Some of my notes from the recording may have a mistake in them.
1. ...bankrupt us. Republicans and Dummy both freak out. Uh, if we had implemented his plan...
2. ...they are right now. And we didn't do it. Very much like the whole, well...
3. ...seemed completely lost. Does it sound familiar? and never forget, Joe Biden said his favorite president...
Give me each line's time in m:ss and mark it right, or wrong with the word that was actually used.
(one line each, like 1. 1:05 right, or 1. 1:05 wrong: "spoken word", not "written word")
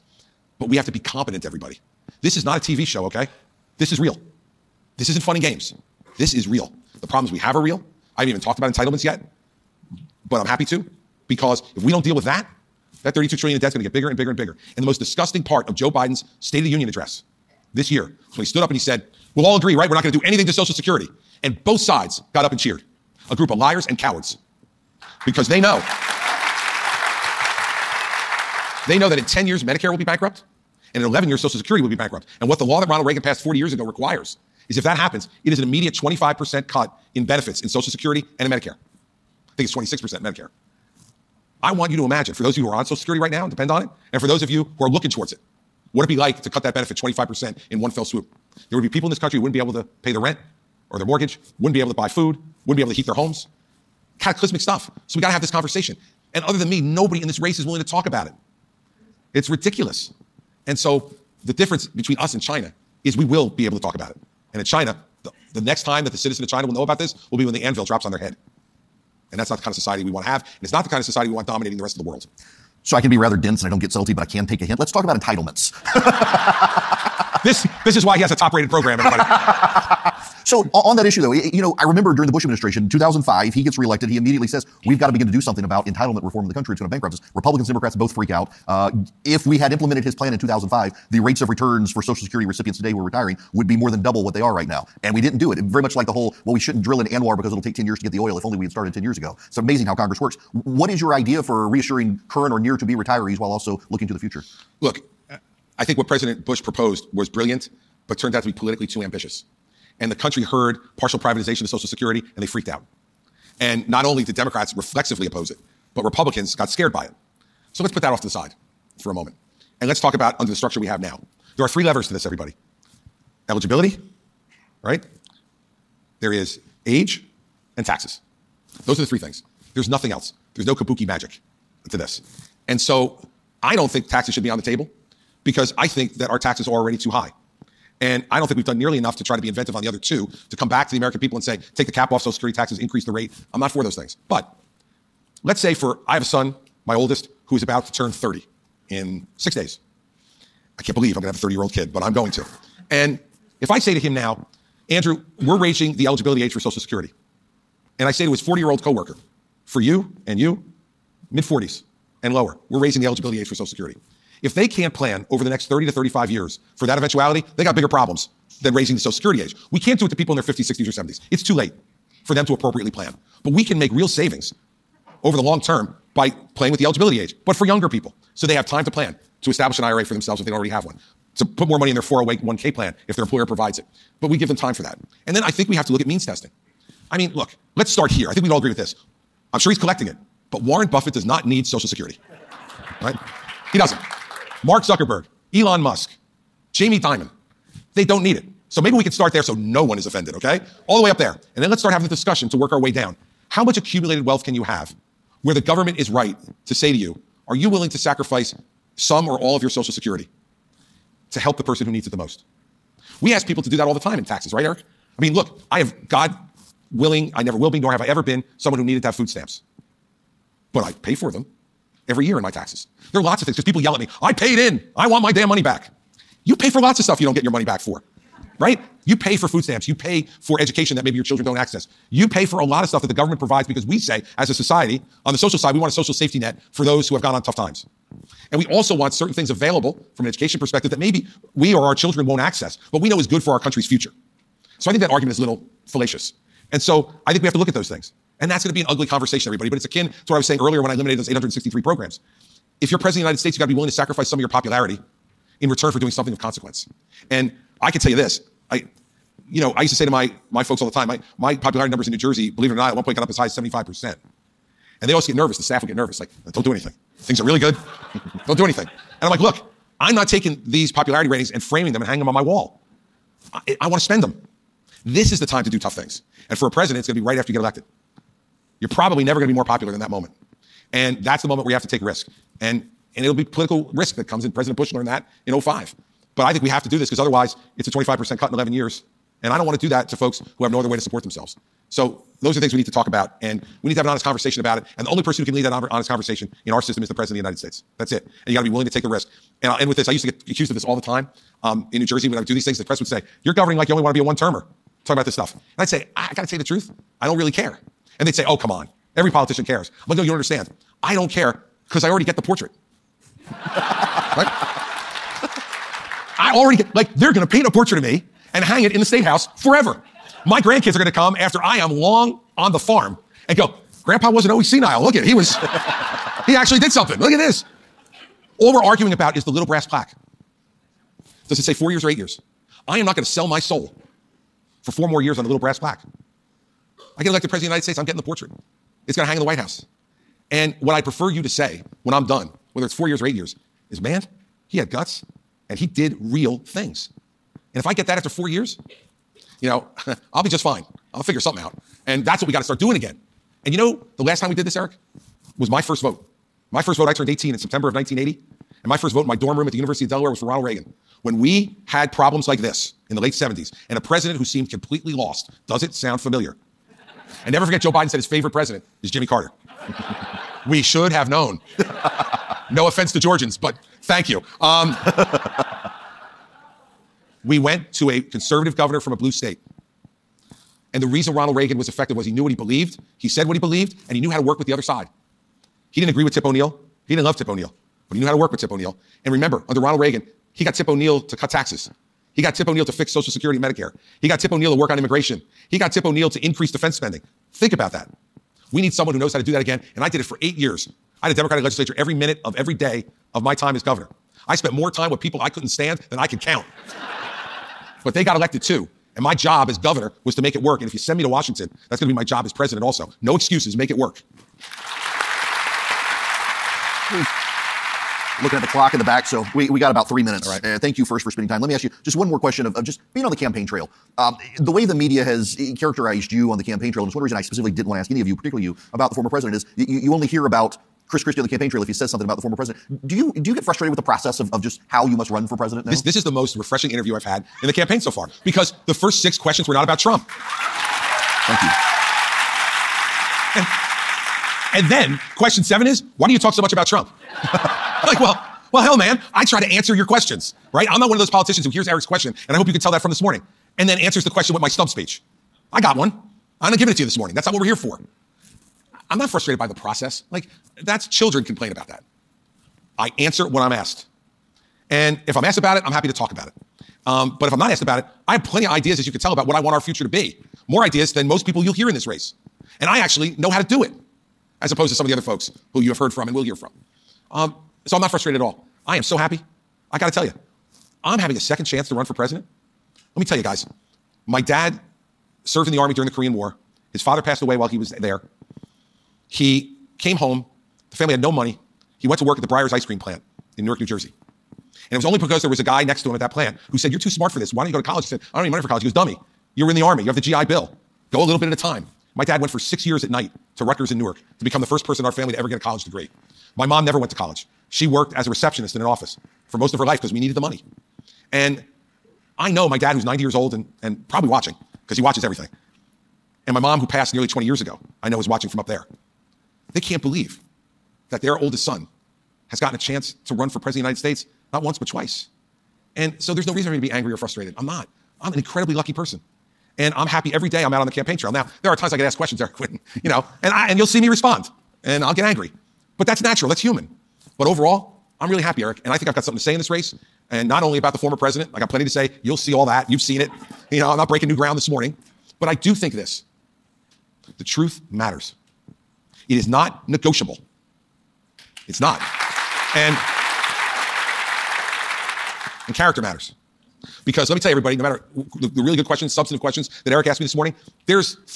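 1. 1:26 wrong: "Democrats", not "Dummy"
2. 1:34 right
3. 6:04 right.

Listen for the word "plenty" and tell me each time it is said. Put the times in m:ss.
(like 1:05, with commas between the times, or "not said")
7:48, 9:01.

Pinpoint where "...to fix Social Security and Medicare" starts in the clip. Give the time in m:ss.
6:32.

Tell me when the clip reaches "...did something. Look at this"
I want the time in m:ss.
5:26.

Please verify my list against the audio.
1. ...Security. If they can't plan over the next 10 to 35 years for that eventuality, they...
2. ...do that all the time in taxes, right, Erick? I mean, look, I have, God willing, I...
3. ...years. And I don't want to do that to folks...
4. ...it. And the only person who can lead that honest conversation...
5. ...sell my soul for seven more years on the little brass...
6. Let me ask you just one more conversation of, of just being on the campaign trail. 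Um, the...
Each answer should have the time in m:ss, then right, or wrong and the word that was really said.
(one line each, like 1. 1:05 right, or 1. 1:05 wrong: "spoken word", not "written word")
1. 2:43 wrong: "30", not "10"
2. 3:33 right
3. 4:48 right
4. 4:54 right
5. 5:33 wrong: "four", not "seven"
6. 7:01 wrong: "question", not "conversation".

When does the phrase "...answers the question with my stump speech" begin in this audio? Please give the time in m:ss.
7:33.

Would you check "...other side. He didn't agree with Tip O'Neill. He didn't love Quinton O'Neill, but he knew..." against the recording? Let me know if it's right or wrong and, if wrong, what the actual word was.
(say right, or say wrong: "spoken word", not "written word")
wrong: "Tip", not "Quinton".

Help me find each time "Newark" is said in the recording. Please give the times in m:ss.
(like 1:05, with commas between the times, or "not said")
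8:13, 8:23.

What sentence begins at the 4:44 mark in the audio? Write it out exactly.
President Bush learned that in 05.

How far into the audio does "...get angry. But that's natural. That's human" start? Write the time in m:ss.
8:55.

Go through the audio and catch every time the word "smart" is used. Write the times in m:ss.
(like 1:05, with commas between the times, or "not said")
8:17.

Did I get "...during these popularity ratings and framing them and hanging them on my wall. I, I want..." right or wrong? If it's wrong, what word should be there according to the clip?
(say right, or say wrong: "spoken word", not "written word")
wrong: "taking", not "during".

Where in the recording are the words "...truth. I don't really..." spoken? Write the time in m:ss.
5:06.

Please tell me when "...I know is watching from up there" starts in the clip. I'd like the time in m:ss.
8:38.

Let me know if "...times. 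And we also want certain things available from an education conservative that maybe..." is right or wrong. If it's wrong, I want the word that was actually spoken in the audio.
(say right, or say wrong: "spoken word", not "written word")
wrong: "perspective", not "conservative".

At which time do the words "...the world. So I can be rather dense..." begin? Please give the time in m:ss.
1:11.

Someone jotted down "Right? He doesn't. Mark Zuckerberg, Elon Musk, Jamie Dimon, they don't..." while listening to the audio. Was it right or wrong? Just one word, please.
right.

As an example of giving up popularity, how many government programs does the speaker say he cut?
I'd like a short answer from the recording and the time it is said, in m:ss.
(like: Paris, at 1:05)
863, at 4:11.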